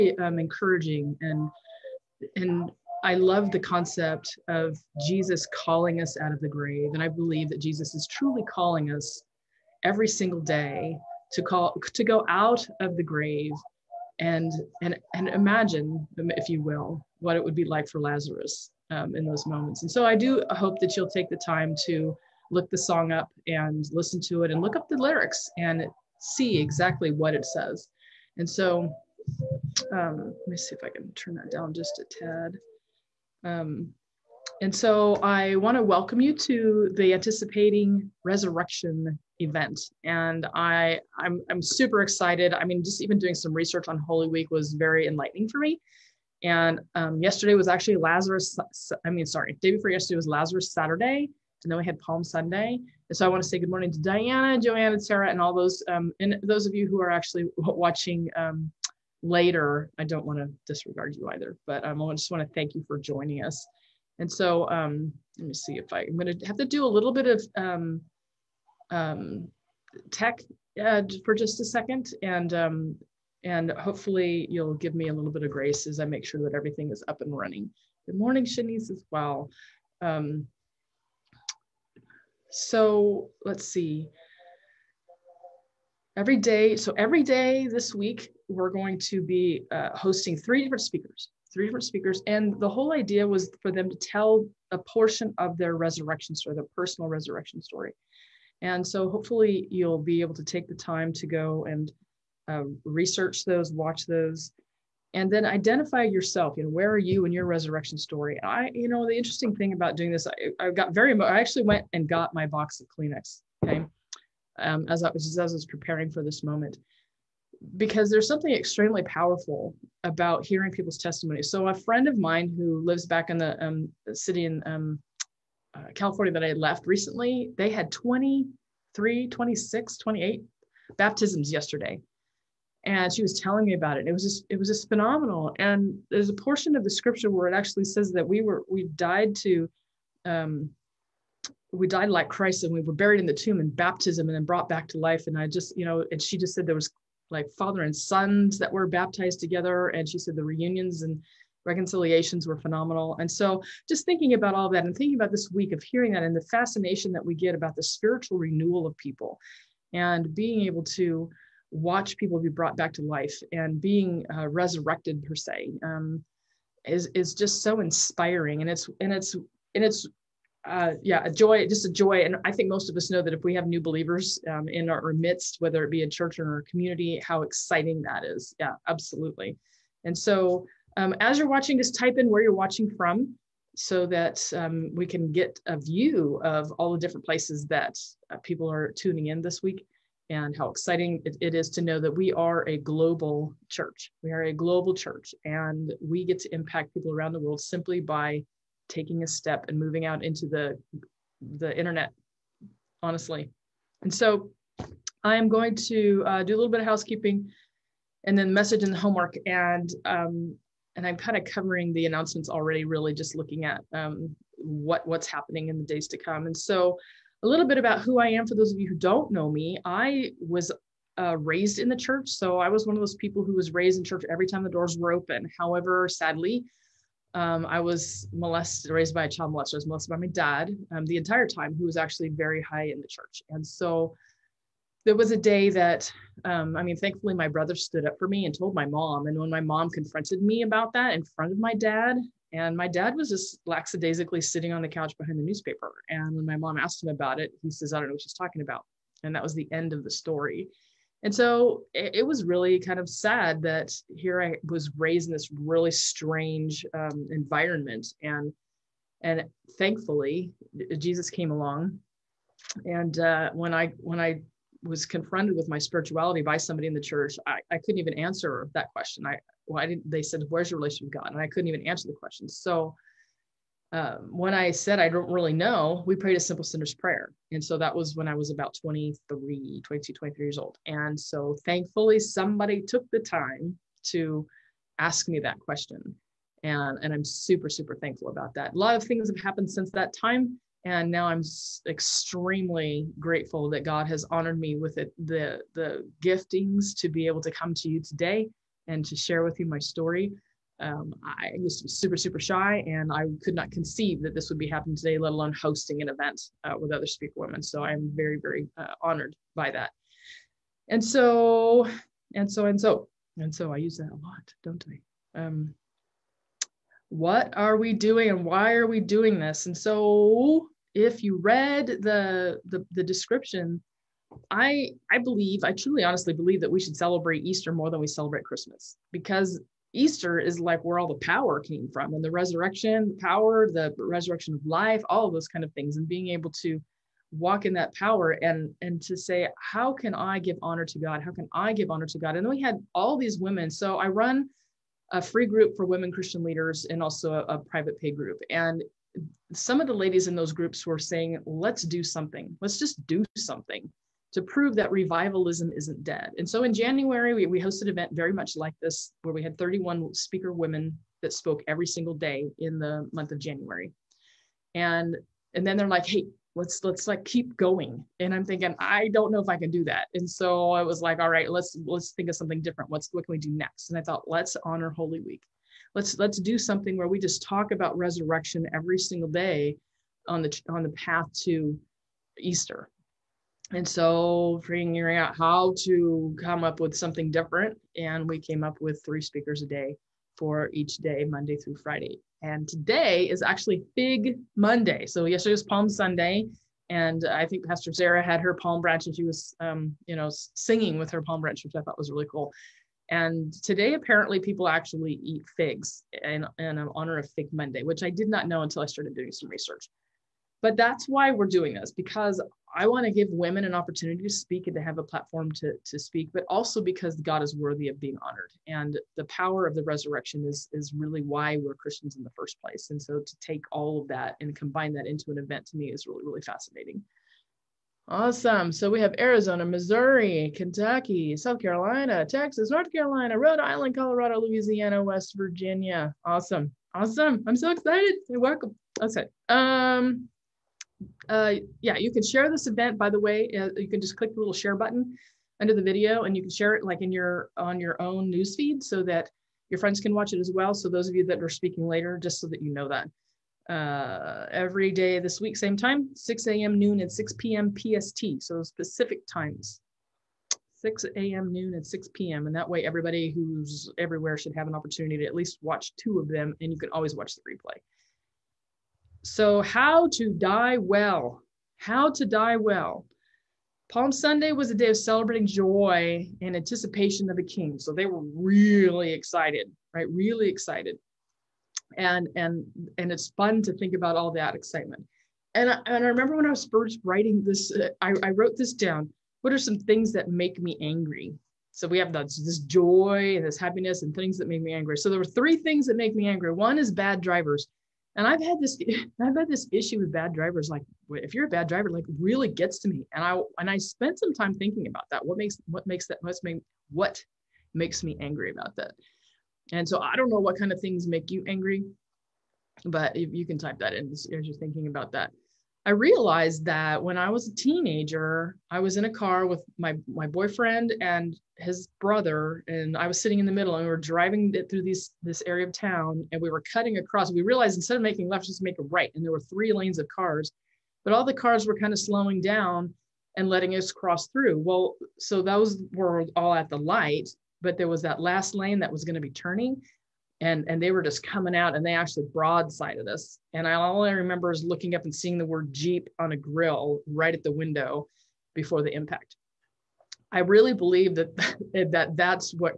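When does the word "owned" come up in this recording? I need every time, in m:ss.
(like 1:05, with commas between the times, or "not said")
not said.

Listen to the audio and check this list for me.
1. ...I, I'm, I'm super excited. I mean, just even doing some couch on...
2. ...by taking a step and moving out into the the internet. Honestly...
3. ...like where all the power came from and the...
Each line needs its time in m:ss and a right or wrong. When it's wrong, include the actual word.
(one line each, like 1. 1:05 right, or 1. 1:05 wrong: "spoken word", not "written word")
1. 0:40 wrong: "research", not "couch"
2. 3:18 right
3. 5:30 right.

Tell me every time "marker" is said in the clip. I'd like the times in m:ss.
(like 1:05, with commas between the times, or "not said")
not said.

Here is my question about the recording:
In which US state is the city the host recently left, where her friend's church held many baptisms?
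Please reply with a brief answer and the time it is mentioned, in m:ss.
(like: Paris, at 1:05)
California, at 2:05.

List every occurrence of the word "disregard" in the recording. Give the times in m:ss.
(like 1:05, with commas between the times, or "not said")
1:00.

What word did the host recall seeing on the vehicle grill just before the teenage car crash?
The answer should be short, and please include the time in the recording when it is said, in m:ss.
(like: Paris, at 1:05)
Jeep, at 9:05.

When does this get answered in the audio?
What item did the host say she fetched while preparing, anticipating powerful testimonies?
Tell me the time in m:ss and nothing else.
1:52.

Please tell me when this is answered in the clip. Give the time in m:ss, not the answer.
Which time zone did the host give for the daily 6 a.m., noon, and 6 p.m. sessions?
7:37.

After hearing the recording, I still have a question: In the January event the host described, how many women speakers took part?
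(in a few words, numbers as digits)
31.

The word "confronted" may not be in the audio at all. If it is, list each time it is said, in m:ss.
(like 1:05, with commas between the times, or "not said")
3:59, 4:25.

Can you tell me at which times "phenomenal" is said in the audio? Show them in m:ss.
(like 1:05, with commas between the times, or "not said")
2:14, 2:32.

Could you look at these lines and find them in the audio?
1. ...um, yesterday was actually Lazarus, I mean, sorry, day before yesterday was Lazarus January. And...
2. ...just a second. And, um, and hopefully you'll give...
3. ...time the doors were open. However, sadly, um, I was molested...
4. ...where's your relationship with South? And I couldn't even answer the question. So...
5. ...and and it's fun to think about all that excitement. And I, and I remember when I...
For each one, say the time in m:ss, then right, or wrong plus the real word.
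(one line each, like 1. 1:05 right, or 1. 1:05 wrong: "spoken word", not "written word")
1. 0:46 wrong: "Saturday", not "January"
2. 1:11 right
3. 3:44 right
4. 4:30 wrong: "God", not "South"
5. 8:02 right.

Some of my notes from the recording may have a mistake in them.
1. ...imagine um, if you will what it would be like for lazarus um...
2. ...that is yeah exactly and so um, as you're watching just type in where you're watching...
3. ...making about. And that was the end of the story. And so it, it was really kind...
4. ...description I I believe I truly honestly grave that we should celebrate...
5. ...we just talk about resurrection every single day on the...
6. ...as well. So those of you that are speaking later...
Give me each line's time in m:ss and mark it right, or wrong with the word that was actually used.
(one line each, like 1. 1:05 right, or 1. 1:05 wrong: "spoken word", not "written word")
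1. 0:15 right
2. 2:58 wrong: "absolutely", not "exactly"
3. 4:08 wrong: "talking", not "making"
4. 5:23 wrong: "believe", not "grave"
5. 6:17 right
6. 7:30 right.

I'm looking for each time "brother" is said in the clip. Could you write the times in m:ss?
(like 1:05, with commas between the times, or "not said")
3:57, 8:42.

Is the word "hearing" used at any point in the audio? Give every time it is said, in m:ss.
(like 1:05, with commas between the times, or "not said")
2:00, 2:35.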